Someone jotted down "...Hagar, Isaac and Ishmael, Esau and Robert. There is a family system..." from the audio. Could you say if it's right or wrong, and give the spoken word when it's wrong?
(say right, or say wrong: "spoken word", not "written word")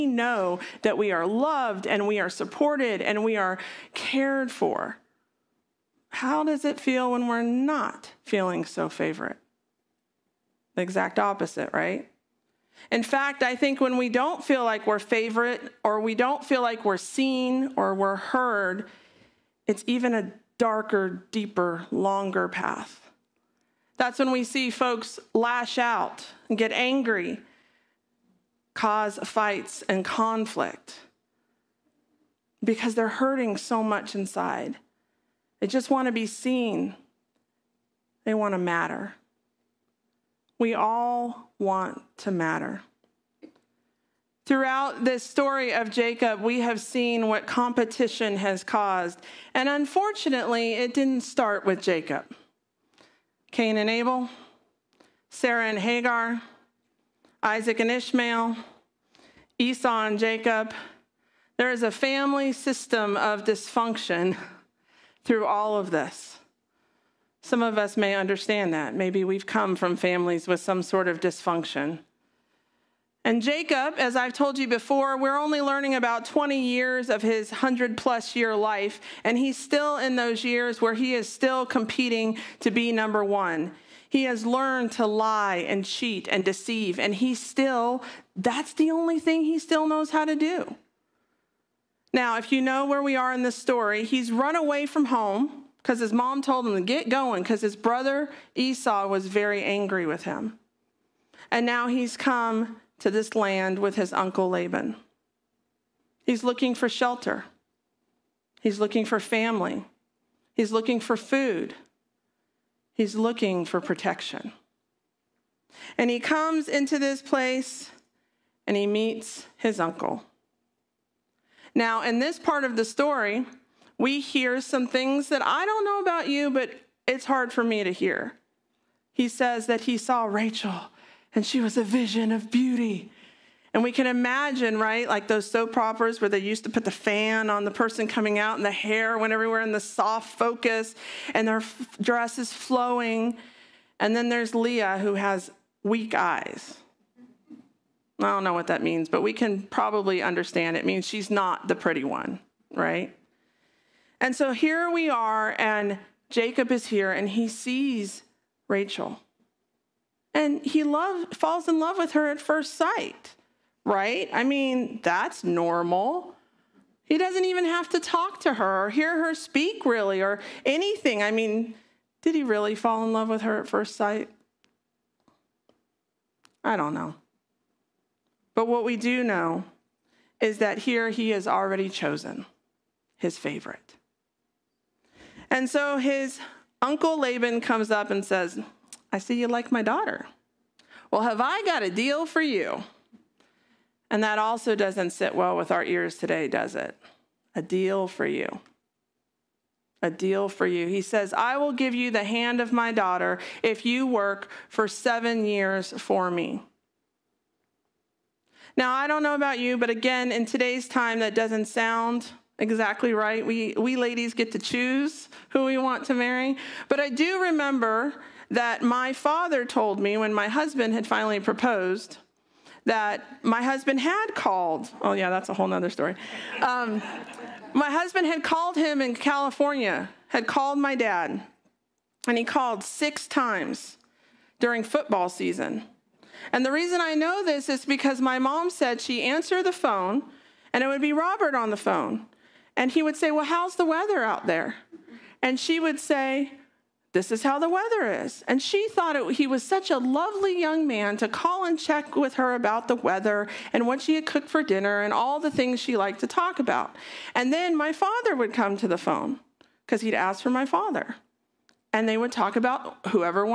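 wrong: "Jacob", not "Robert".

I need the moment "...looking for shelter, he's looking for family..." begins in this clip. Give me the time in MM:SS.
01:46.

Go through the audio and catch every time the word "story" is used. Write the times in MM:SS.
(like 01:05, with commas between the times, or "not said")
00:45, 01:33, 02:02, 03:45.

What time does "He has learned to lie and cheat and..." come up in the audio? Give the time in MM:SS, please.
01:24.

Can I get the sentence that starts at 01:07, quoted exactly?
Some of us may understand that.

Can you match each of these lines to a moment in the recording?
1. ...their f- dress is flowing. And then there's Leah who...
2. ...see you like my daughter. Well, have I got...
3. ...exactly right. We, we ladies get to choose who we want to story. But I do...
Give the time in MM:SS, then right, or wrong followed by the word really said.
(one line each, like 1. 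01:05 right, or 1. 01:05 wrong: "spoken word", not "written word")
1. 02:21 right
2. 03:09 right
3. 03:32 wrong: "marry", not "story".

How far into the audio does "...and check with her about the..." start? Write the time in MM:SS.
04:11.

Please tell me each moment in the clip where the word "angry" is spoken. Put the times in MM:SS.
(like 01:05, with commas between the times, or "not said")
00:26, 01:39.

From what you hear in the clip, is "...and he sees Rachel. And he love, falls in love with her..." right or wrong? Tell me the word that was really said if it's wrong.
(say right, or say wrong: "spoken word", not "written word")
right.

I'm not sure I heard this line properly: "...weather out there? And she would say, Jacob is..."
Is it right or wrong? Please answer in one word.
wrong.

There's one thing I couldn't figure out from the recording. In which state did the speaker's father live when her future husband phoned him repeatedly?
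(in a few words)
California.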